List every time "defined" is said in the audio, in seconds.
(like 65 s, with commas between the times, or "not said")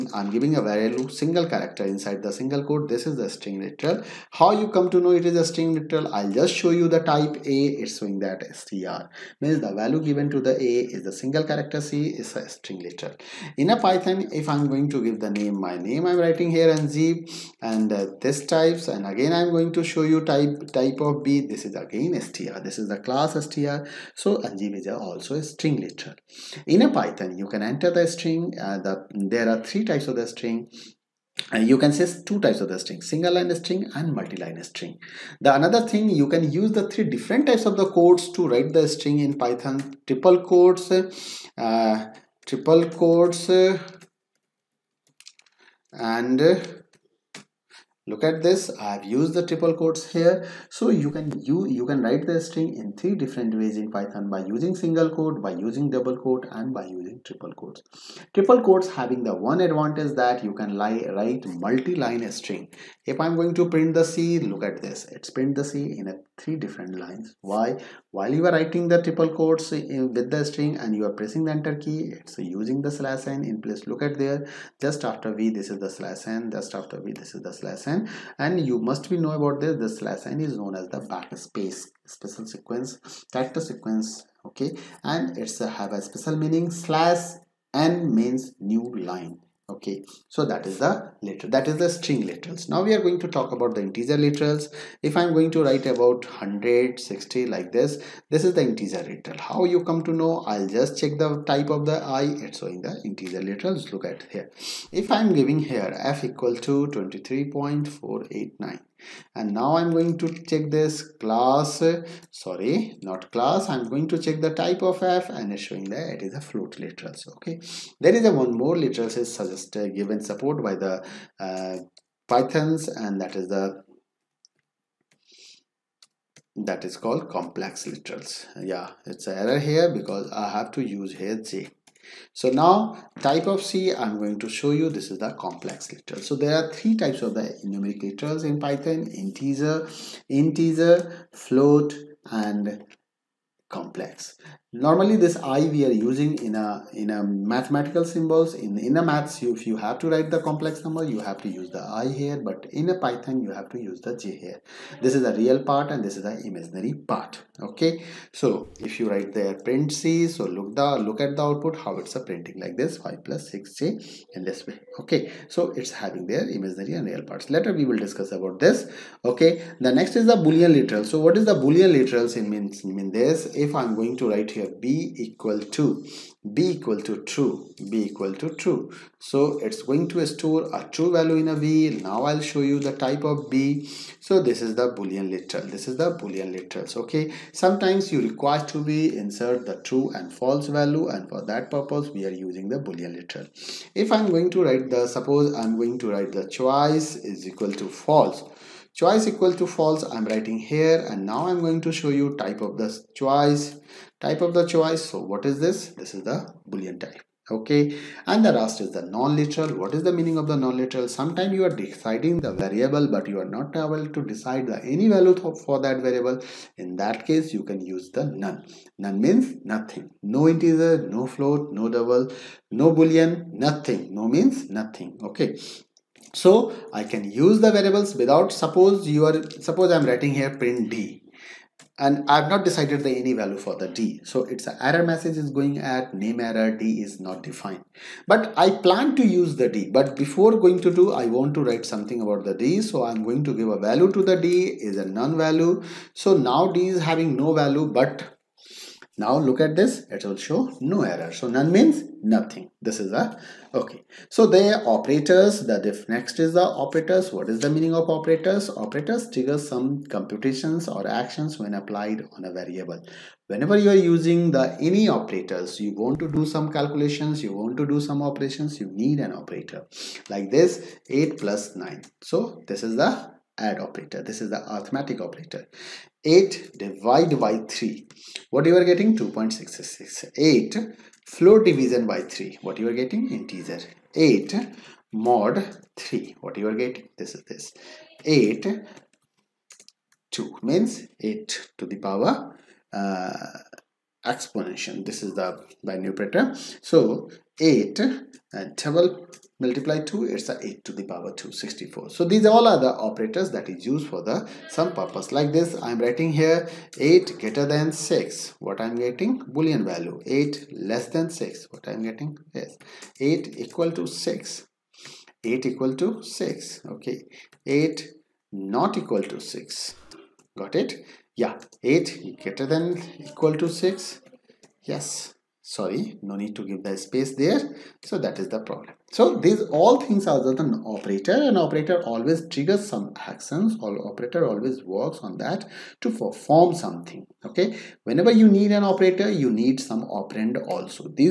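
237 s.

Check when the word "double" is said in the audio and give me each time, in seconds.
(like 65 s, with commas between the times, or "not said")
55 s, 221 s, 298 s.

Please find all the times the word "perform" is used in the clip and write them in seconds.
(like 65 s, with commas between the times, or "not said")
336 s.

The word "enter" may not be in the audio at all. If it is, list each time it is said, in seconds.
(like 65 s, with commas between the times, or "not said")
27 s, 71 s.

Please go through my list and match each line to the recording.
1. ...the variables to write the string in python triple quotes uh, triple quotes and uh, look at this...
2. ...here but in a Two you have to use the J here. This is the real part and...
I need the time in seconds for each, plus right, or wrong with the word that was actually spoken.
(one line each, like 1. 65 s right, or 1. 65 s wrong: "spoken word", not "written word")
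1. 37 s wrong: "codes", not "variables"
2. 152 s wrong: "Python", not "Two".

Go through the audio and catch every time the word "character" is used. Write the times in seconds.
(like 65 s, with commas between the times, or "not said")
1 s, 11 s, 83 s.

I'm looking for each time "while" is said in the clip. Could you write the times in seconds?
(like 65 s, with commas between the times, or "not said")
68 s.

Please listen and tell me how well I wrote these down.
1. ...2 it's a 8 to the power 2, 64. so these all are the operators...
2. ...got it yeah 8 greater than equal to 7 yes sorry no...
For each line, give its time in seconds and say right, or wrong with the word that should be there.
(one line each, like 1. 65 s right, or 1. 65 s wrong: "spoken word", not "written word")
1. 300 s right
2. 320 s wrong: "6", not "7".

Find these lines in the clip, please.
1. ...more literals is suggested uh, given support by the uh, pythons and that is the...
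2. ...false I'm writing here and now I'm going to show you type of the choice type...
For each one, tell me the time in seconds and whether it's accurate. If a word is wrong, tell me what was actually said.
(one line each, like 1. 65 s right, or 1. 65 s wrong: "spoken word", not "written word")
1. 118 s right
2. 199 s right.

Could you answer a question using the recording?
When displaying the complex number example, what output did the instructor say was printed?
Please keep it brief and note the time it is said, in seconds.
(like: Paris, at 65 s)
5+6j, at 162 s.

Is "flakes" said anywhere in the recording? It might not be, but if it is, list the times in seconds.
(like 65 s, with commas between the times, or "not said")
not said.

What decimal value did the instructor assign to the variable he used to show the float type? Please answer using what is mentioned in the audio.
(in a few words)
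23.489.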